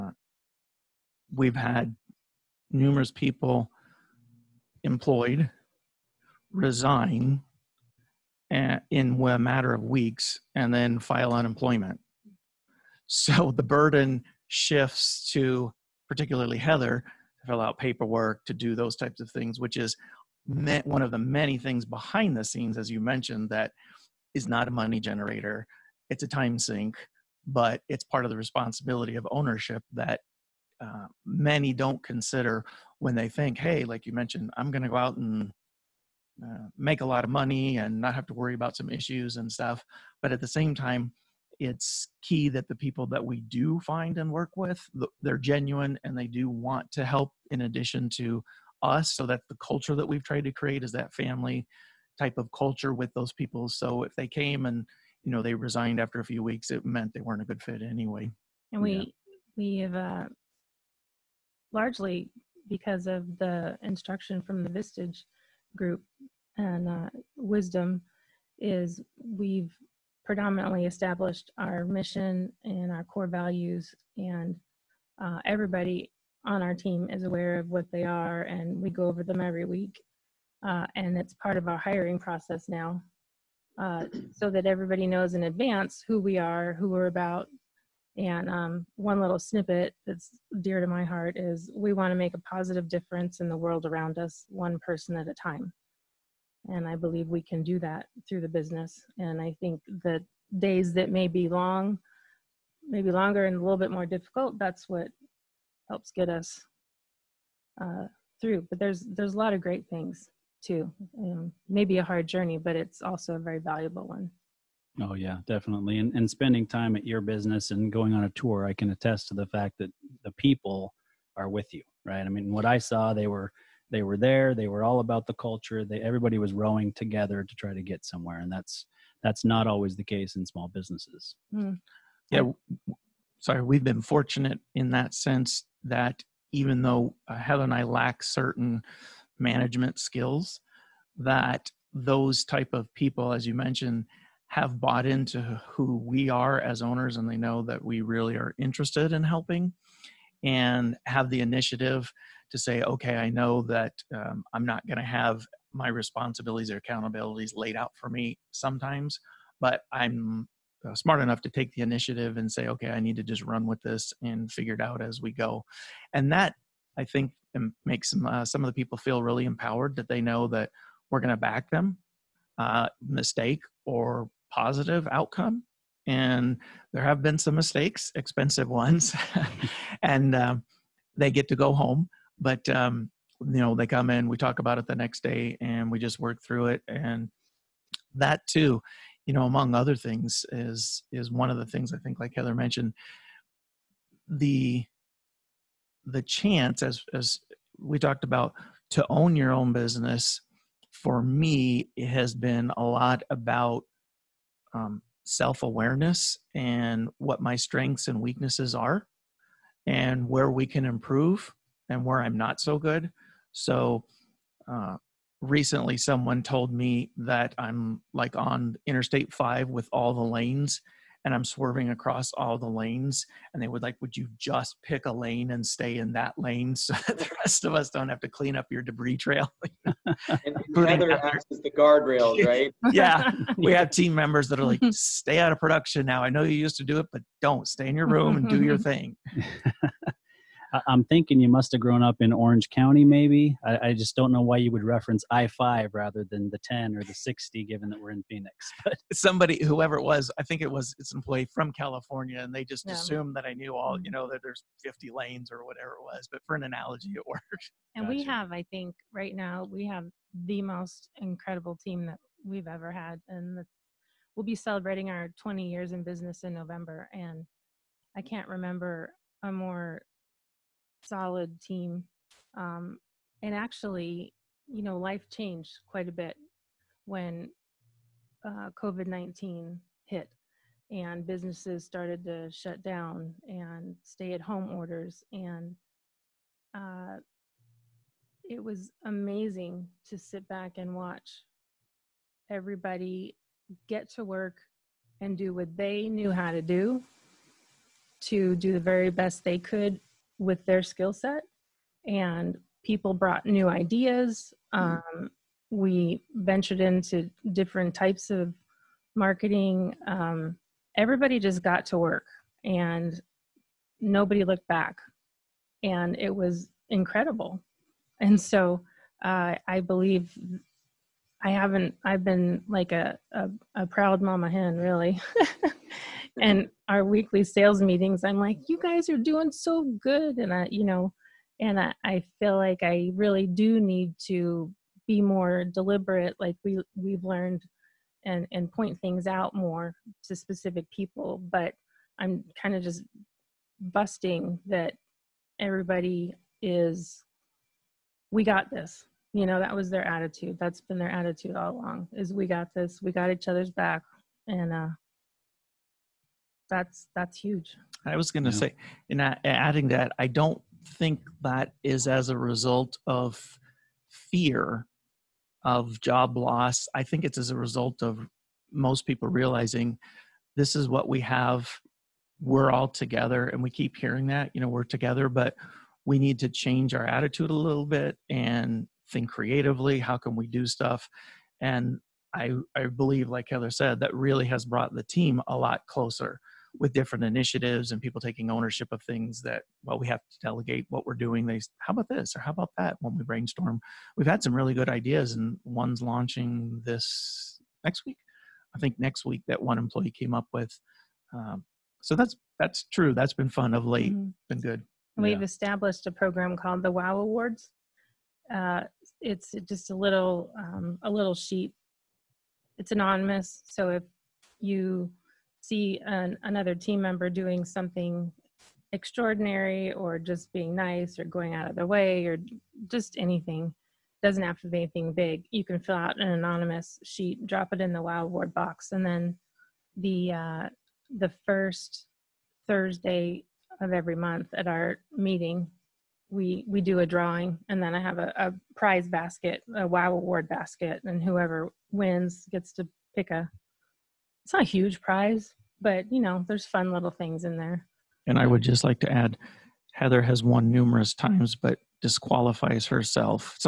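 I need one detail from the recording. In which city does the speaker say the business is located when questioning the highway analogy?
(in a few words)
Phoenix.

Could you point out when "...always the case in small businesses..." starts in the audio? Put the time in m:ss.
2:09.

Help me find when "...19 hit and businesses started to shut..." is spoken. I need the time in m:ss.
4:39.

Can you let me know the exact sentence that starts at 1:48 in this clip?
But there's there's a lot of great things too.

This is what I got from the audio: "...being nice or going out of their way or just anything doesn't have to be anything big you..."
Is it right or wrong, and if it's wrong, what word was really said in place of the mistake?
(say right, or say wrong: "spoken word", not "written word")
right.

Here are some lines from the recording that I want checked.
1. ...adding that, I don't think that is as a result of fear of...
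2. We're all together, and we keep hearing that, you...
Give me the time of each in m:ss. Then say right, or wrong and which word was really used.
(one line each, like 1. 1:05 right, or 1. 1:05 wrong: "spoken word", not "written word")
1. 5:59 right
2. 6:12 right.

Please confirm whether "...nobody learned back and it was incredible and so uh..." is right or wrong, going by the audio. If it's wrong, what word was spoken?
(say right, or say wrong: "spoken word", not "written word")
wrong: "looked", not "learned".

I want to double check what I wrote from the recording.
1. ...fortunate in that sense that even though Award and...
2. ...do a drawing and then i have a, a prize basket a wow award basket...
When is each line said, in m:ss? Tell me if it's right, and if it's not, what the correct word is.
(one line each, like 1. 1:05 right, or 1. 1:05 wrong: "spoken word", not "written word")
1. 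2:14 wrong: "Heather", not "Award"
2. 7:16 right.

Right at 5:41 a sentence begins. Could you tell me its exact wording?
But I'm kind of just busting that everybody is, we got this.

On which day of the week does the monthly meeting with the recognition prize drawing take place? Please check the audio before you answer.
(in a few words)
Thursday.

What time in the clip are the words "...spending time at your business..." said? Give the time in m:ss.
1:56.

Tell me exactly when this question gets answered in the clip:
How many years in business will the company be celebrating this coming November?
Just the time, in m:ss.
4:25.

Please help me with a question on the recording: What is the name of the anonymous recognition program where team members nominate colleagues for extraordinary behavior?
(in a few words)
Wow Awards.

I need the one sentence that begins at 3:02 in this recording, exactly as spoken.
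But um, you know, they come in, we talk about it the next day, and we just work through it.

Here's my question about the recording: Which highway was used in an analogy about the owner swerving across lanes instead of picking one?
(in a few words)
Interstate 5.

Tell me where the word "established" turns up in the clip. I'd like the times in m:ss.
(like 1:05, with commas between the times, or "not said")
1:10, 6:45.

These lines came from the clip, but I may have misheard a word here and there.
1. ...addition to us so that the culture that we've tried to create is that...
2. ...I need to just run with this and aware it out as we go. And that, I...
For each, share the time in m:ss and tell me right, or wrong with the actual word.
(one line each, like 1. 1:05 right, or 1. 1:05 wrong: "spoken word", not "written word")
1. 0:47 right
2. 2:42 wrong: "figure", not "aware".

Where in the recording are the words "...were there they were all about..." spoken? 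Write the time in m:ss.
2:04.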